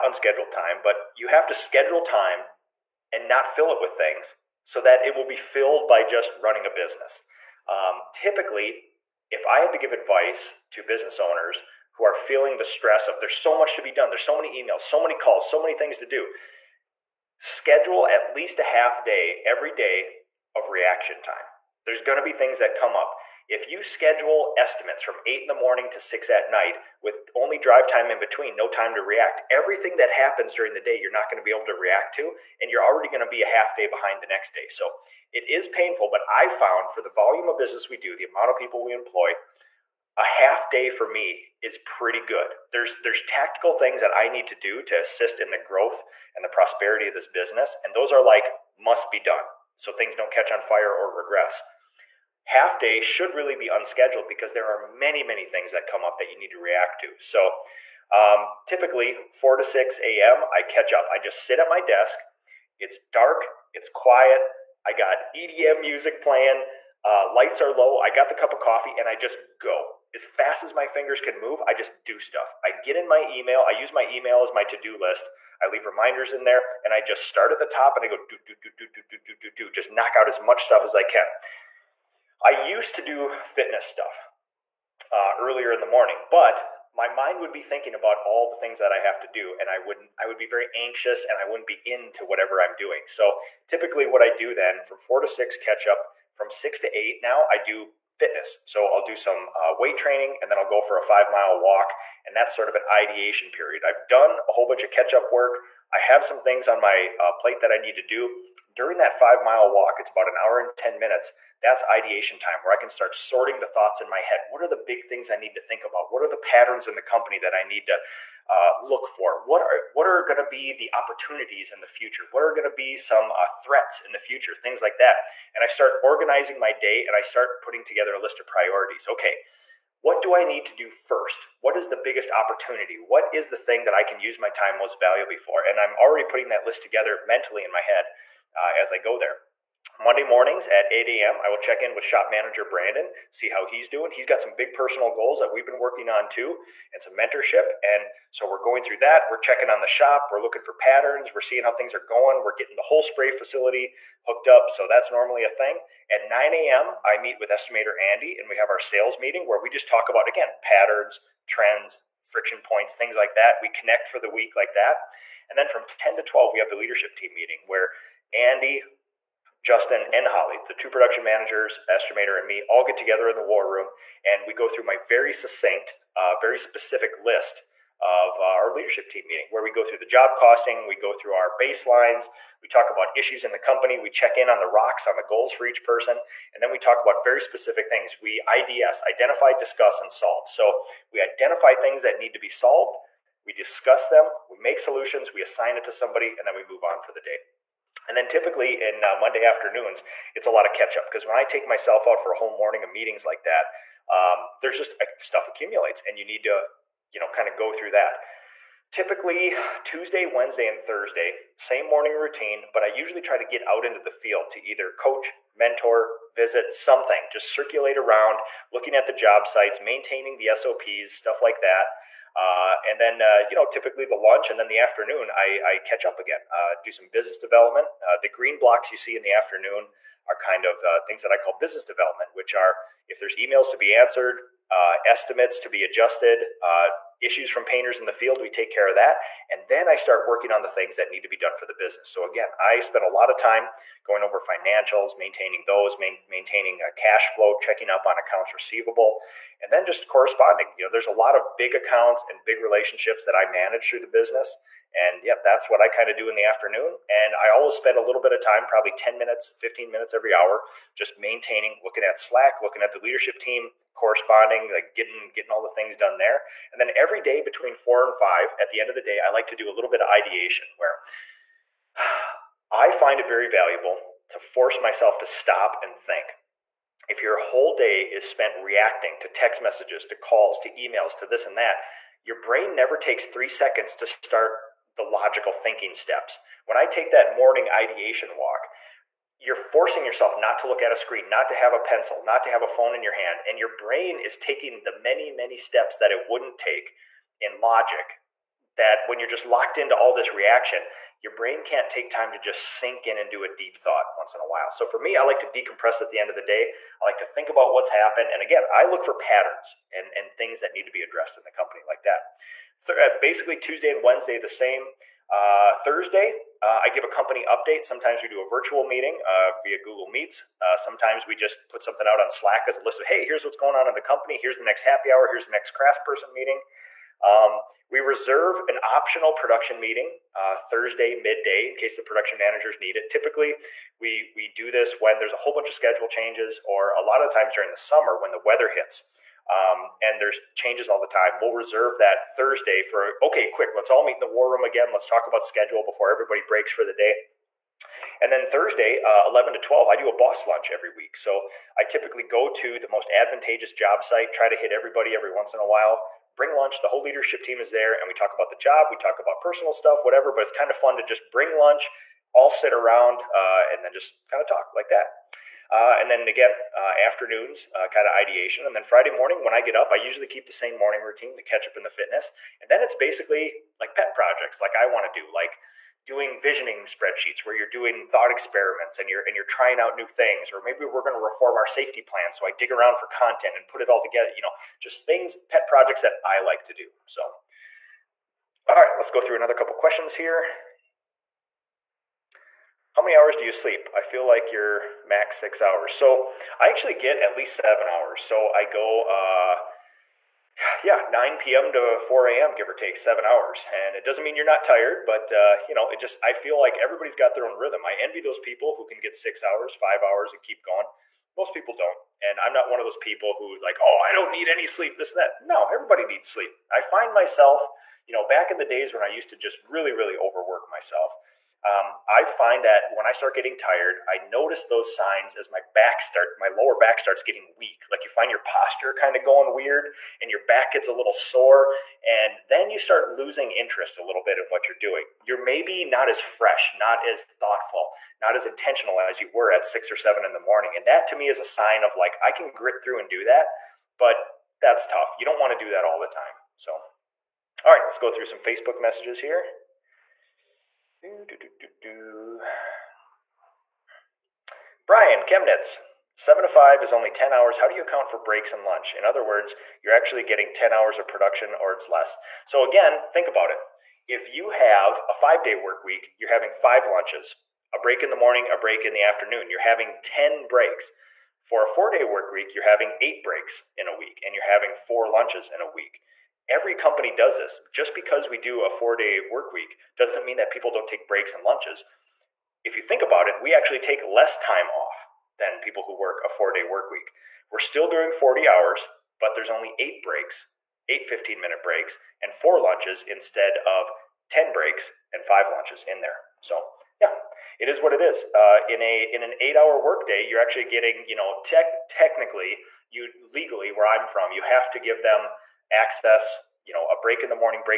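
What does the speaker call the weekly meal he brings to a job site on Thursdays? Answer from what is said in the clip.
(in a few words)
boss lunch.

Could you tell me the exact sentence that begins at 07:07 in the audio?
Like you find your posture kind of going weird and your back gets a little sore.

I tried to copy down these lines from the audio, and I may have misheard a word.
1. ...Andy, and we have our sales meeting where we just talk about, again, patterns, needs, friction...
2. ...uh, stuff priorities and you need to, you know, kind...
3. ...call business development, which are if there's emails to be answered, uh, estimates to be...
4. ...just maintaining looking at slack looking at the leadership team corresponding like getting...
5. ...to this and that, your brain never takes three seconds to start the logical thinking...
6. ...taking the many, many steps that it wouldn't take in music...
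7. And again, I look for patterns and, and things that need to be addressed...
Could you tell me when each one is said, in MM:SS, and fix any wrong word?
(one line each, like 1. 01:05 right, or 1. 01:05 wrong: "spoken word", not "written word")
1. 02:37 wrong: "trends", not "needs"
2. 03:24 wrong: "accumulates", not "priorities"
3. 03:51 right
4. 04:20 right
5. 04:41 right
6. 04:54 wrong: "logic", not "music"
7. 05:08 right.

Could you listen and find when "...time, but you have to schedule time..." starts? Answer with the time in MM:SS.
00:00.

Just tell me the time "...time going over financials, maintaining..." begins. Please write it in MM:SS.
04:03.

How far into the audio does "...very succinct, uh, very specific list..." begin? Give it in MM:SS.
02:54.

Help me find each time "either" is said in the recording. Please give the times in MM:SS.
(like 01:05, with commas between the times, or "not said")
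03:34.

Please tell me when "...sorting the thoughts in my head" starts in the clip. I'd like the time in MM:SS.
01:53.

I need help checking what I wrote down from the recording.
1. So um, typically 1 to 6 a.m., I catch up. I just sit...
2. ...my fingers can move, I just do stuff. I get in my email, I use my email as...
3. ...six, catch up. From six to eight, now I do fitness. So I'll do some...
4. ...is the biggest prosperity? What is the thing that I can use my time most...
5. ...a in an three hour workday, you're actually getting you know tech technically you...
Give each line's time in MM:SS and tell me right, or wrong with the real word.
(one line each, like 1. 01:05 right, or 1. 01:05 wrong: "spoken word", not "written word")
1. 00:57 wrong: "4", not "1"
2. 01:10 right
3. 01:35 right
4. 02:11 wrong: "opportunity", not "prosperity"
5. 08:18 wrong: "eight", not "three".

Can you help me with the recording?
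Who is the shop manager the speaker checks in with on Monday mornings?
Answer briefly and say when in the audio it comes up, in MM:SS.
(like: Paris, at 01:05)
Brandon, at 02:22.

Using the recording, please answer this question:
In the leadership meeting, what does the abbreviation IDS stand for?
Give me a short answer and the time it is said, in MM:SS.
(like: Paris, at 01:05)
identify, discuss, and solve, at 03:09.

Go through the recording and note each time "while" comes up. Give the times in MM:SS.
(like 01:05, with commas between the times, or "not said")
05:04, 05:55.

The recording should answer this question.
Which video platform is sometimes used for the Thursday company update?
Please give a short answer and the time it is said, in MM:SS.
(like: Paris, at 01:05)
Google Meets, at 05:19.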